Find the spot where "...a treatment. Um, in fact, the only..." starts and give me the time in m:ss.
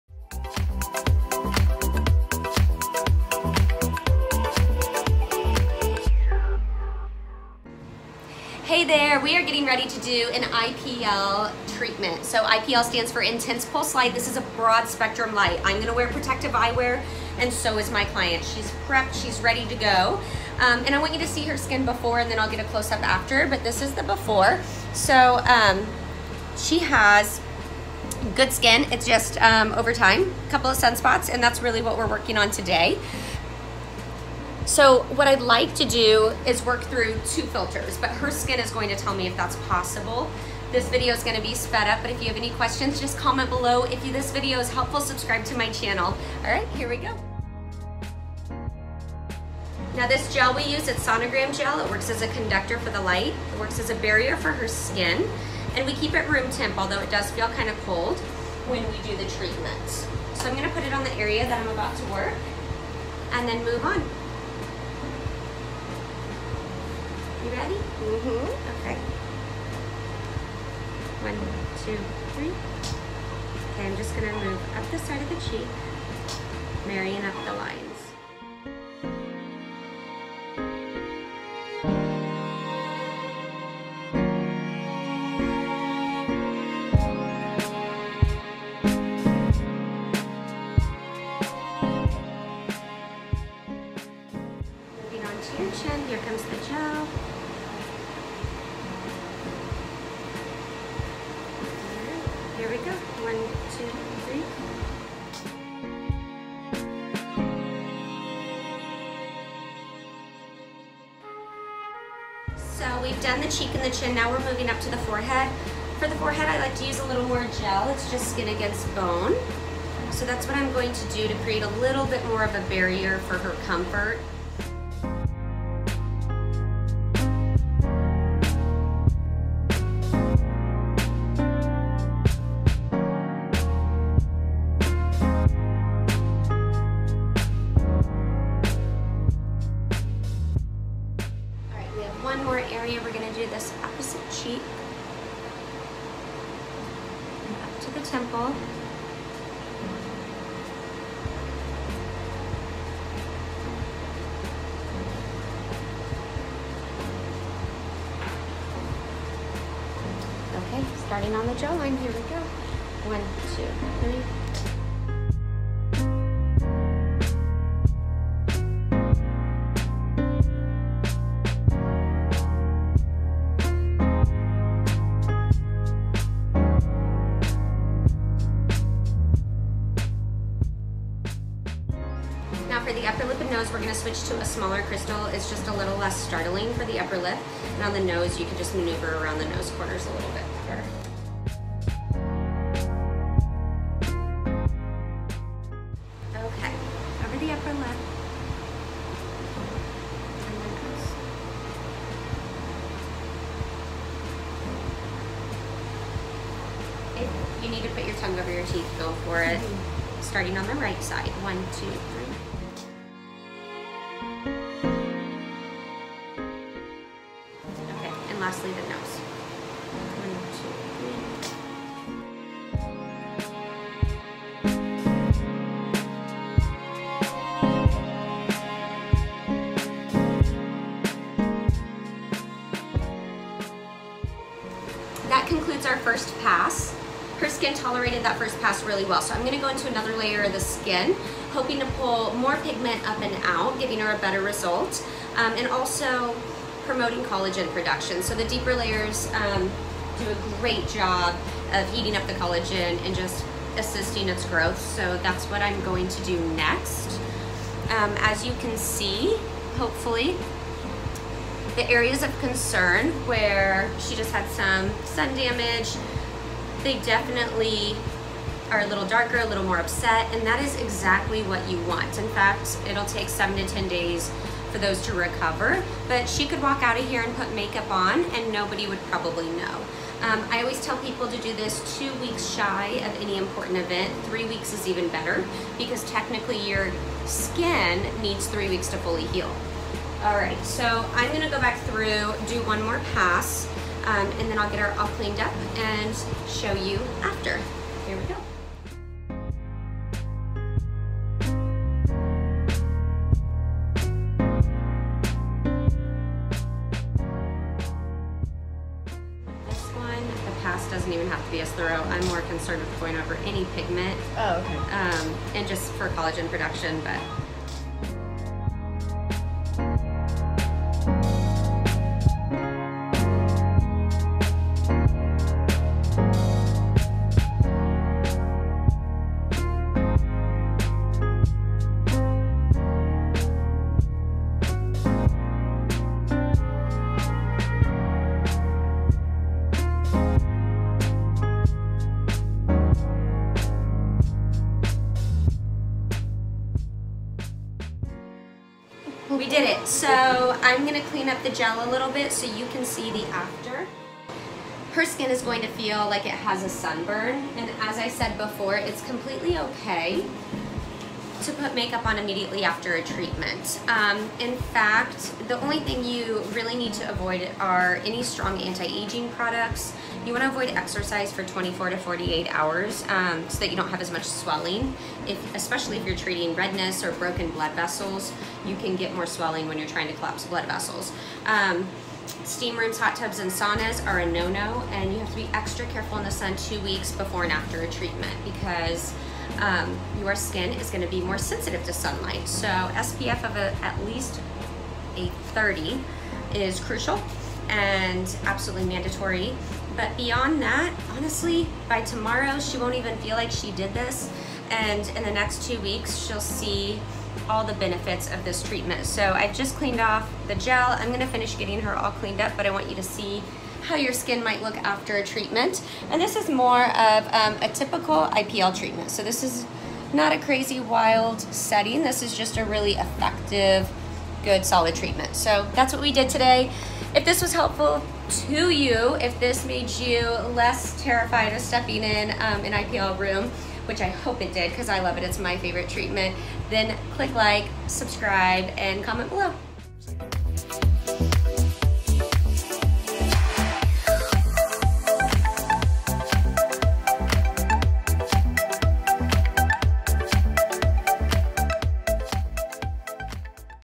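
6:02.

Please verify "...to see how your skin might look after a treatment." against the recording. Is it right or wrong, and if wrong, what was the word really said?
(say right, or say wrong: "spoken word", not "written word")
right.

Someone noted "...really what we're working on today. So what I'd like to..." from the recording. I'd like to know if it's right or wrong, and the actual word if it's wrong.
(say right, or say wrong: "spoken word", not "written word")
right.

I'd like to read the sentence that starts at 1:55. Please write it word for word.
For the forehead, I like to use a little more gel.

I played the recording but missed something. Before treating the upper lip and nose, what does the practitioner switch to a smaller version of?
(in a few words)
crystal.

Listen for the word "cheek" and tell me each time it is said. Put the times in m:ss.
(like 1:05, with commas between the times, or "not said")
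1:15, 1:53, 2:24.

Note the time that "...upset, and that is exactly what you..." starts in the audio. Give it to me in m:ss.
4:29.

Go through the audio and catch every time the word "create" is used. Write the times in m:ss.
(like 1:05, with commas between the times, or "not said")
2:01.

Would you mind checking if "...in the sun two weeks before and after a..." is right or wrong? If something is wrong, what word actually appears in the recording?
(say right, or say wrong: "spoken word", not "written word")
right.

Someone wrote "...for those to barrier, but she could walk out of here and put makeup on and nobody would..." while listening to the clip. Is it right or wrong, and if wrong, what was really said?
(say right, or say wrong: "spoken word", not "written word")
wrong: "recover", not "barrier".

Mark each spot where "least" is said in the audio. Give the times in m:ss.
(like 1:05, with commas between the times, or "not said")
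6:34.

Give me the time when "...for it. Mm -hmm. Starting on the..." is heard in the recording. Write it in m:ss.
3:29.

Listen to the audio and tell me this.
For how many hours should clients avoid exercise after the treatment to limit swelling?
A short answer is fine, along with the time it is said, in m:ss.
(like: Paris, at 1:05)
24 to 48, at 6:11.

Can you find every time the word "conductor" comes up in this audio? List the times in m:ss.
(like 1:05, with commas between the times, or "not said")
0:52.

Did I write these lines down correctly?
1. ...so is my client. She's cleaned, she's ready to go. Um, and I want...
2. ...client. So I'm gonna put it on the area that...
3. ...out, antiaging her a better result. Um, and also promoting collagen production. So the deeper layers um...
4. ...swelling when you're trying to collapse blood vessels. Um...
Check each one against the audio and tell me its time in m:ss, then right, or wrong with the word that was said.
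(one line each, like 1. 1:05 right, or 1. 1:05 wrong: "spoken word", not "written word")
1. 0:17 wrong: "prepped", not "cleaned"
2. 0:59 wrong: "treatment", not "client"
3. 4:03 wrong: "giving", not "antiaging"
4. 6:19 right.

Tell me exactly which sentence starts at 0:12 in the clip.
So IPL stands for Intense Pulse Light.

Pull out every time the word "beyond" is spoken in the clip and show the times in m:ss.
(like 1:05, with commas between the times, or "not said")
6:40.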